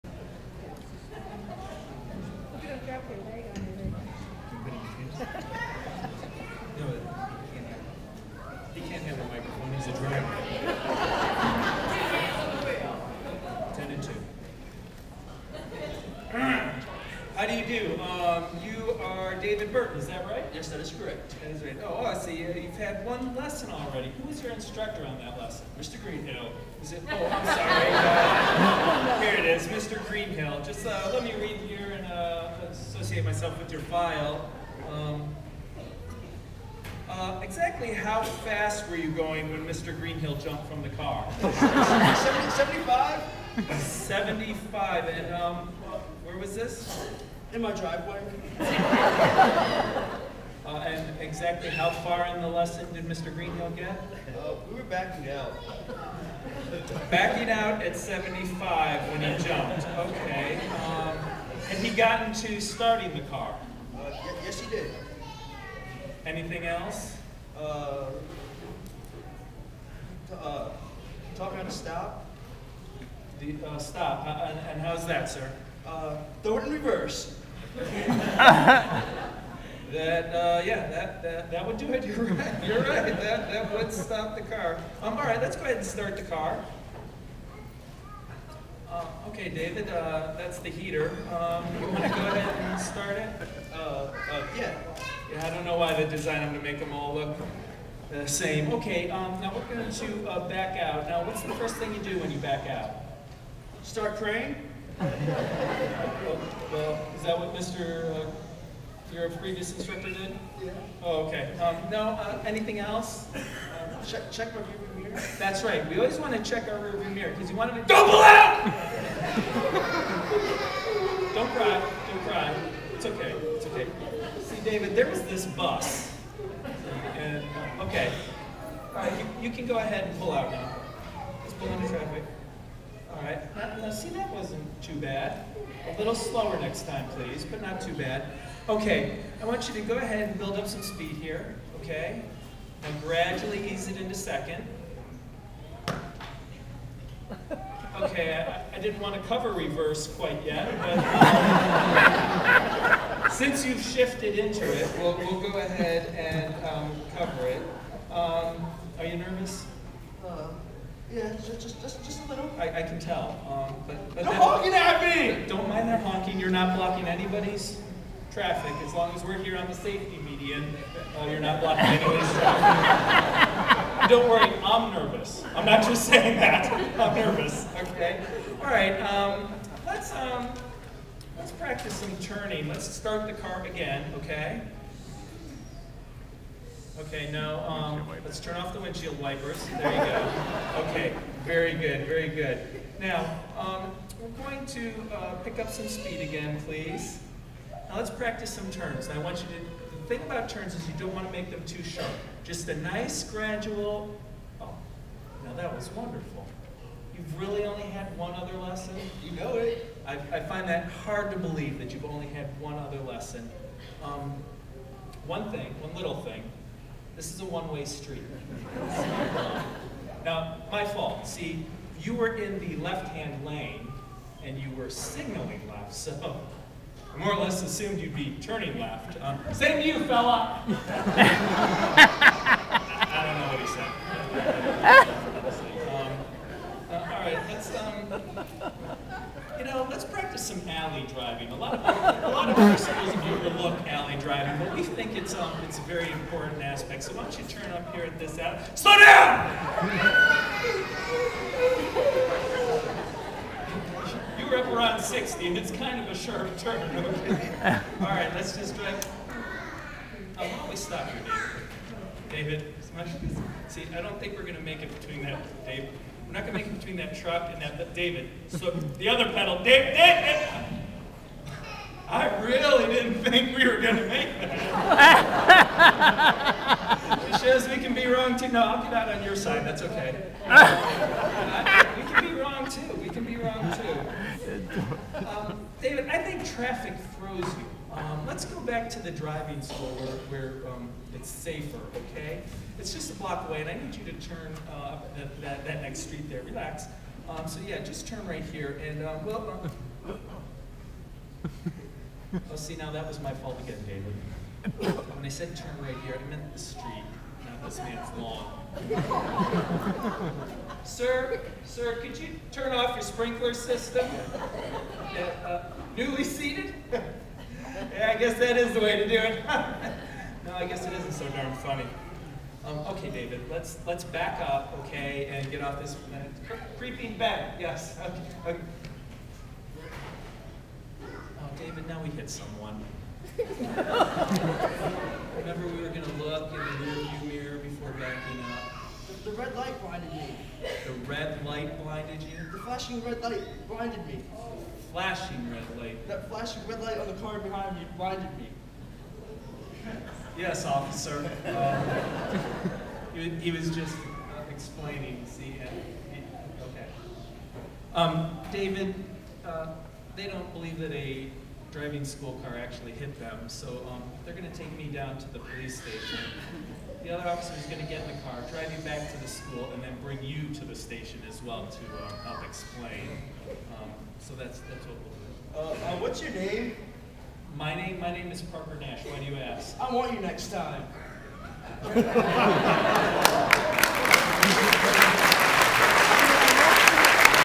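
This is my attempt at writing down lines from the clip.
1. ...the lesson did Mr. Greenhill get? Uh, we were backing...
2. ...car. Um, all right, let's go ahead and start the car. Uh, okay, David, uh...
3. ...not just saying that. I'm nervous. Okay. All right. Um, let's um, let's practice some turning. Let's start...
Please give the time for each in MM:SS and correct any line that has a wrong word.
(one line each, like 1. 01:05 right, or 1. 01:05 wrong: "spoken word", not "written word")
1. 00:52 right
2. 01:24 right
3. 02:55 right.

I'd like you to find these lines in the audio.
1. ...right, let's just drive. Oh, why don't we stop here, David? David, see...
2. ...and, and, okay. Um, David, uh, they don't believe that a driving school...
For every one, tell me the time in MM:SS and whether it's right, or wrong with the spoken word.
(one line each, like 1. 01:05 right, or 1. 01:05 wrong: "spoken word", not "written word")
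1. 04:18 right
2. 05:55 right.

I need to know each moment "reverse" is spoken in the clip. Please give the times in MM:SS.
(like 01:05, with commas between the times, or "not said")
01:16, 02:29.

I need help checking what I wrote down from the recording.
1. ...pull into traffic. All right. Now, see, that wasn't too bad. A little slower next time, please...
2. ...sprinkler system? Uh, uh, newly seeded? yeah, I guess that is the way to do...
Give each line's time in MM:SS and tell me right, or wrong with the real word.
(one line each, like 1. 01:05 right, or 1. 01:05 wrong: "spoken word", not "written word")
1. 02:11 right
2. 05:13 right.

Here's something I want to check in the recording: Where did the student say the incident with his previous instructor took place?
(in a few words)
in my driveway.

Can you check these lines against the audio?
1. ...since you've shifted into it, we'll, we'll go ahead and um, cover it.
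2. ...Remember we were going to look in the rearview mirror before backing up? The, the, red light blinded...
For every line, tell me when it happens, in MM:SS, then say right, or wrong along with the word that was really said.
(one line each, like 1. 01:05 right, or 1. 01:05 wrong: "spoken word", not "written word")
1. 02:33 right
2. 05:33 right.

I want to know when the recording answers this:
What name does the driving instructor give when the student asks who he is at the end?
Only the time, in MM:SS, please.
06:18.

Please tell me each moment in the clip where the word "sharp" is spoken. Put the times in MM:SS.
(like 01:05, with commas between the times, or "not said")
03:21, 04:16.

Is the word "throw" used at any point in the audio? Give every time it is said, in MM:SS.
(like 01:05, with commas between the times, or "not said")
01:16, 04:47.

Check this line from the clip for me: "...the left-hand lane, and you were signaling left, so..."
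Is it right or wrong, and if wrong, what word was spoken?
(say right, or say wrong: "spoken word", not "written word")
right.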